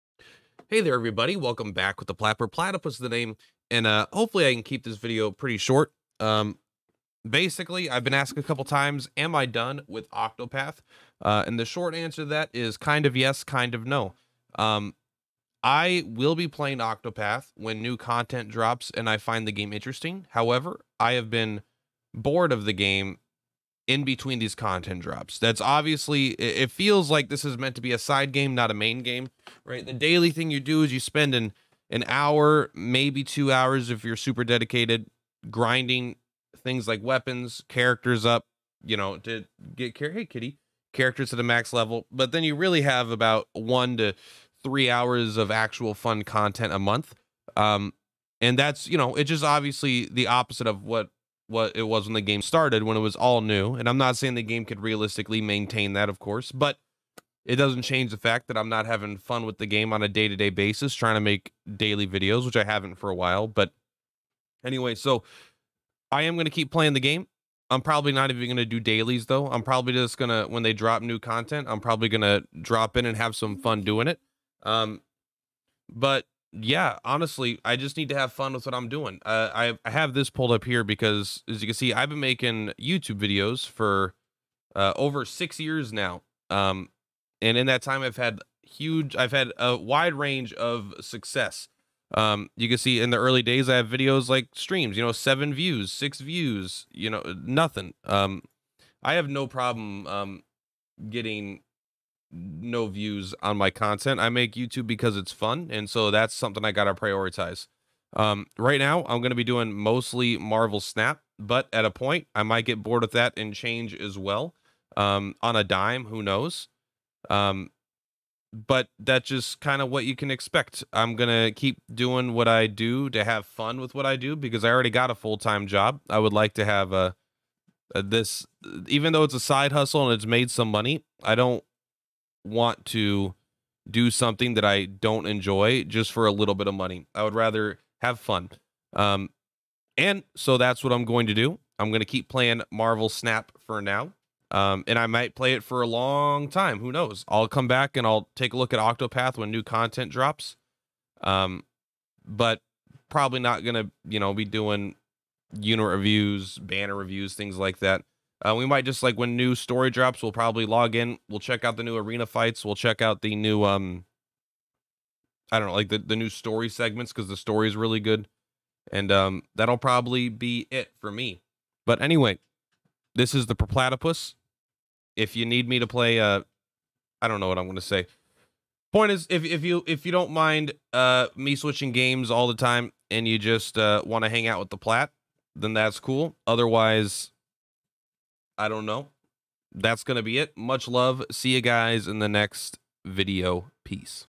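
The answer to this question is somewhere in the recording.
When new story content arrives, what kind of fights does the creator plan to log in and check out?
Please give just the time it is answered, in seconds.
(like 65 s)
161 s.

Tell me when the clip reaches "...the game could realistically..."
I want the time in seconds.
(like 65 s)
54 s.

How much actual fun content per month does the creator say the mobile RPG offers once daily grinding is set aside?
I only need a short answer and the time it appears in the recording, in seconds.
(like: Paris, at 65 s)
1 to 3 hours, at 43 s.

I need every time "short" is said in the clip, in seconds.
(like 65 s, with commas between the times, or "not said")
5 s, 11 s.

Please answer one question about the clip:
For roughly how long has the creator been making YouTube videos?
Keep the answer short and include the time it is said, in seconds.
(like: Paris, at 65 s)
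Over 6 years, at 84 s.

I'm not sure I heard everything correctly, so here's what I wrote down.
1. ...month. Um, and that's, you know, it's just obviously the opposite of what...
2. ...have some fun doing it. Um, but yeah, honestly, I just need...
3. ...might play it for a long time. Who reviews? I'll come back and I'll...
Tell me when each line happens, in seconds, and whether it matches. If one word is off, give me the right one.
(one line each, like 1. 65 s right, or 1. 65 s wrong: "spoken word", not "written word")
1. 46 s right
2. 73 s right
3. 145 s wrong: "knows", not "reviews".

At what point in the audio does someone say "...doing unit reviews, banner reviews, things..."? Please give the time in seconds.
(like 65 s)
154 s.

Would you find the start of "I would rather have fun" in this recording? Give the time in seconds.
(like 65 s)
137 s.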